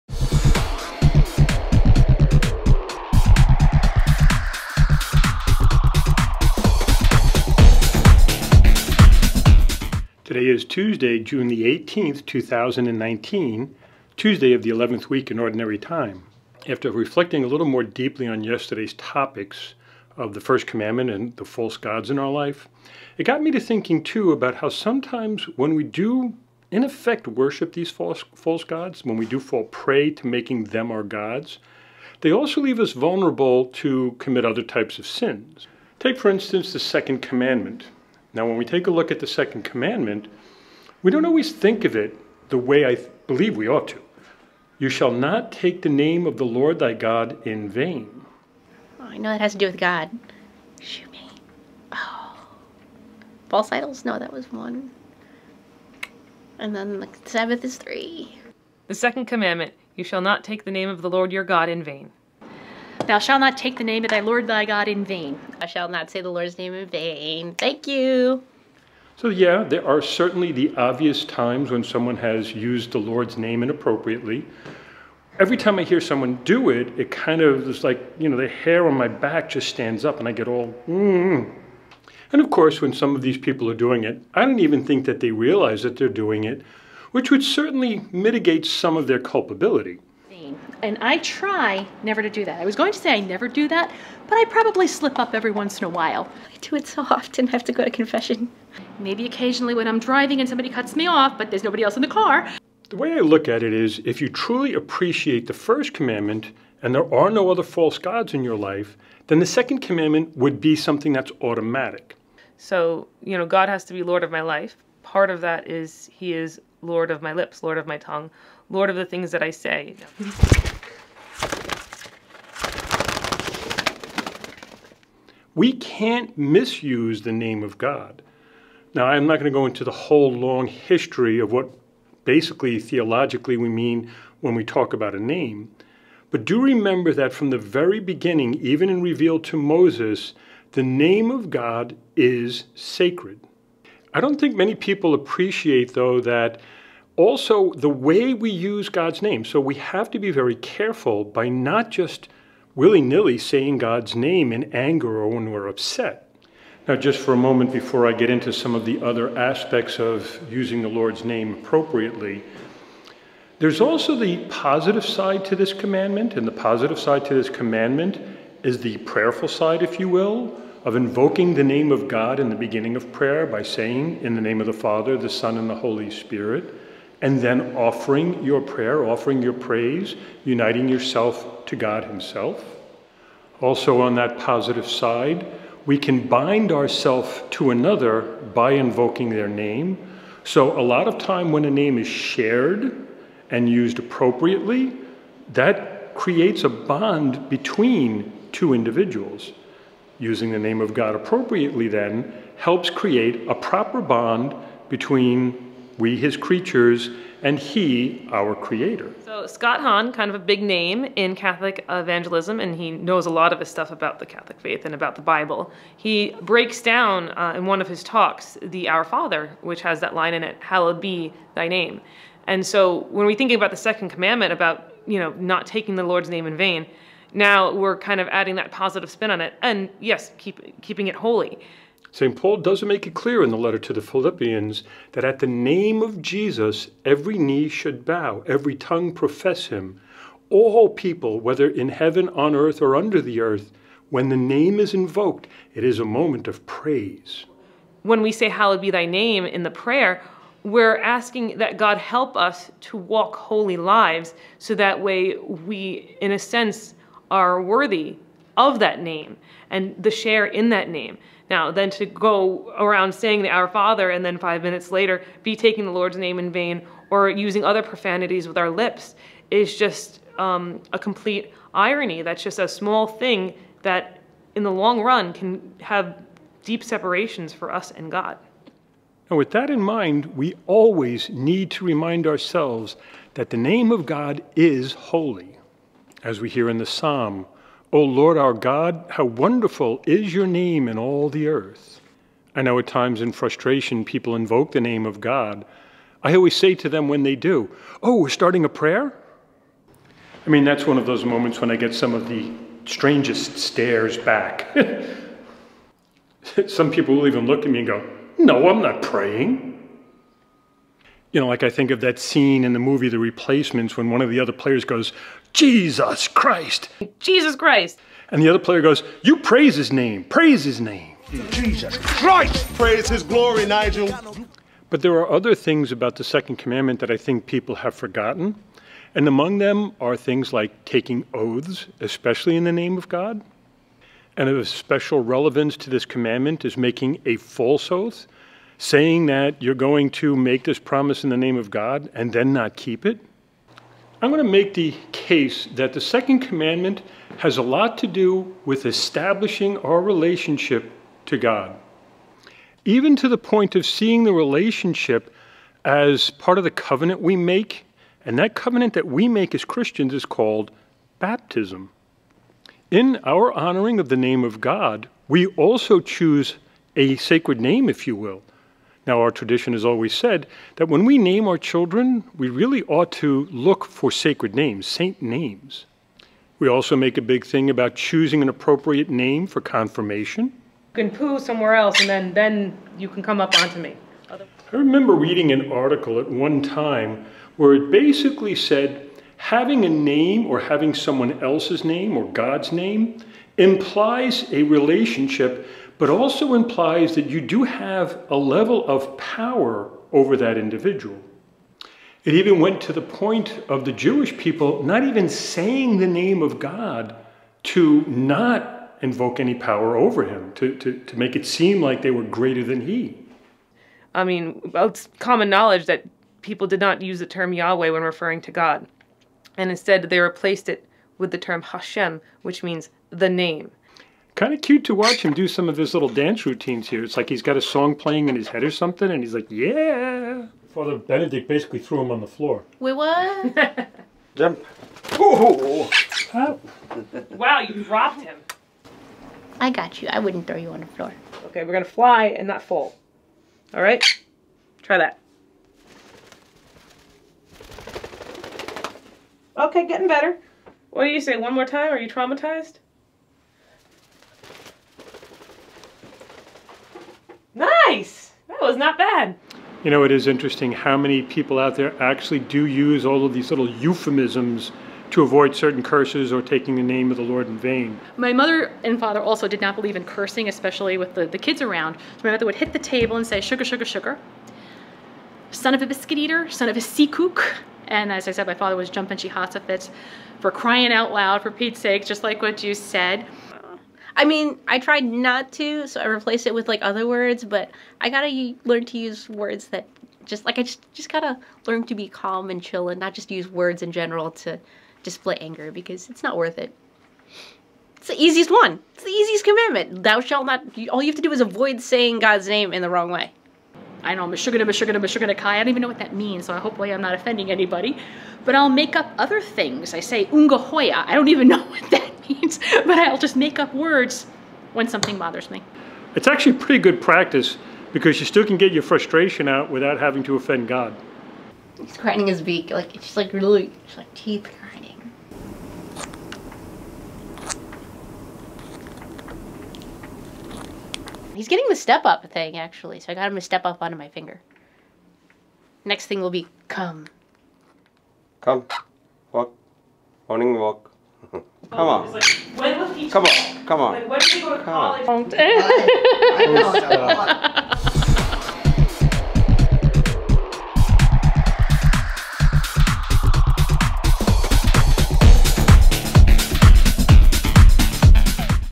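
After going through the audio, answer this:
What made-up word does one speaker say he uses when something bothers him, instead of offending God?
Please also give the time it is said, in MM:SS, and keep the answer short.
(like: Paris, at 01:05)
Ungahoya, at 08:30.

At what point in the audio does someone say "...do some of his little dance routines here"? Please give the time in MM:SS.
07:05.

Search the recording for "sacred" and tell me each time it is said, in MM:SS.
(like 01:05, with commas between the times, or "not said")
02:22, 06:07, 06:14.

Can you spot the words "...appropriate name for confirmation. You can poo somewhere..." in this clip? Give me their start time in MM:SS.
06:18.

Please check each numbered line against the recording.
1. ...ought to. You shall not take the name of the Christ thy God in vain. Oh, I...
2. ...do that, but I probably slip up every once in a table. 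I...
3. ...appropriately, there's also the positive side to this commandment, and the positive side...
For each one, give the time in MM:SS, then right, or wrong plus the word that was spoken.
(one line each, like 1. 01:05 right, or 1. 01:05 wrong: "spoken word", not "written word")
1. 00:43 wrong: "Lord", not "Christ"
2. 01:33 wrong: "while", not "table"
3. 02:41 right.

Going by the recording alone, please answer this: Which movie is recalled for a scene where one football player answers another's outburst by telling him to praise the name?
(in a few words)
The Replacements.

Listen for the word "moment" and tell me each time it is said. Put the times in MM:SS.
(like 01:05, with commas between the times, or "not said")
02:37, 04:06, 05:01.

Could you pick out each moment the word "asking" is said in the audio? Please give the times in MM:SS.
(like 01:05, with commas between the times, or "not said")
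04:10.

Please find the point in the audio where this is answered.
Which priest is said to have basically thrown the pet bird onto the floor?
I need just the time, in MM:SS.
07:10.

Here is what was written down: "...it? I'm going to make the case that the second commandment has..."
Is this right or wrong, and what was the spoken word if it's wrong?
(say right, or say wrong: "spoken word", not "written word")
right.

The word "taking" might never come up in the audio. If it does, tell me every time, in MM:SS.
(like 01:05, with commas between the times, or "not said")
03:45, 04:25, 05:30, 07:46.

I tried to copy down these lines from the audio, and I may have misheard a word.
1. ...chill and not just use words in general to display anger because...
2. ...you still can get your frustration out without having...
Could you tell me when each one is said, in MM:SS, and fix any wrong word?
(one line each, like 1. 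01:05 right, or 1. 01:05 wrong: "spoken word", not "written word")
1. 08:12 right
2. 08:38 right.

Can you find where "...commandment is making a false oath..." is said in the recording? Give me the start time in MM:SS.
05:36.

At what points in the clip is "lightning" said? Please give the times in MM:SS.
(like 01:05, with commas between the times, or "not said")
not said.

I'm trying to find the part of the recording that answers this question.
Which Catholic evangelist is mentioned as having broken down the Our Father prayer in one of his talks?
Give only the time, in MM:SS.
03:29.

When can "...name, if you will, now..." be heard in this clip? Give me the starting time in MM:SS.
06:07.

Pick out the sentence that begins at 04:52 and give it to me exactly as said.
I know at times in frustration people invoke the name of God.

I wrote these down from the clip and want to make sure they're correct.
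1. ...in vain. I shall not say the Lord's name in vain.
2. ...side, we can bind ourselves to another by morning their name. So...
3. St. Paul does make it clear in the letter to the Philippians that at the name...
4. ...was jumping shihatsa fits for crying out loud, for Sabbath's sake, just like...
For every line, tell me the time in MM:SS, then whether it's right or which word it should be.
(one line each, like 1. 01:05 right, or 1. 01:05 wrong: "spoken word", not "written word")
1. 01:04 right
2. 03:04 wrong: "invoking", not "morning"
3. 03:52 right
4. 07:58 wrong: "Pete", not "Sabbath".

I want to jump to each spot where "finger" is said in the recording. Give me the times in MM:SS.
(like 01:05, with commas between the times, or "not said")
08:54.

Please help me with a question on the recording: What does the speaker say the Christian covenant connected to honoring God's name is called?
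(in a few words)
Baptism.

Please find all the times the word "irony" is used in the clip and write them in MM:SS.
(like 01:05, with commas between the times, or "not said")
04:31.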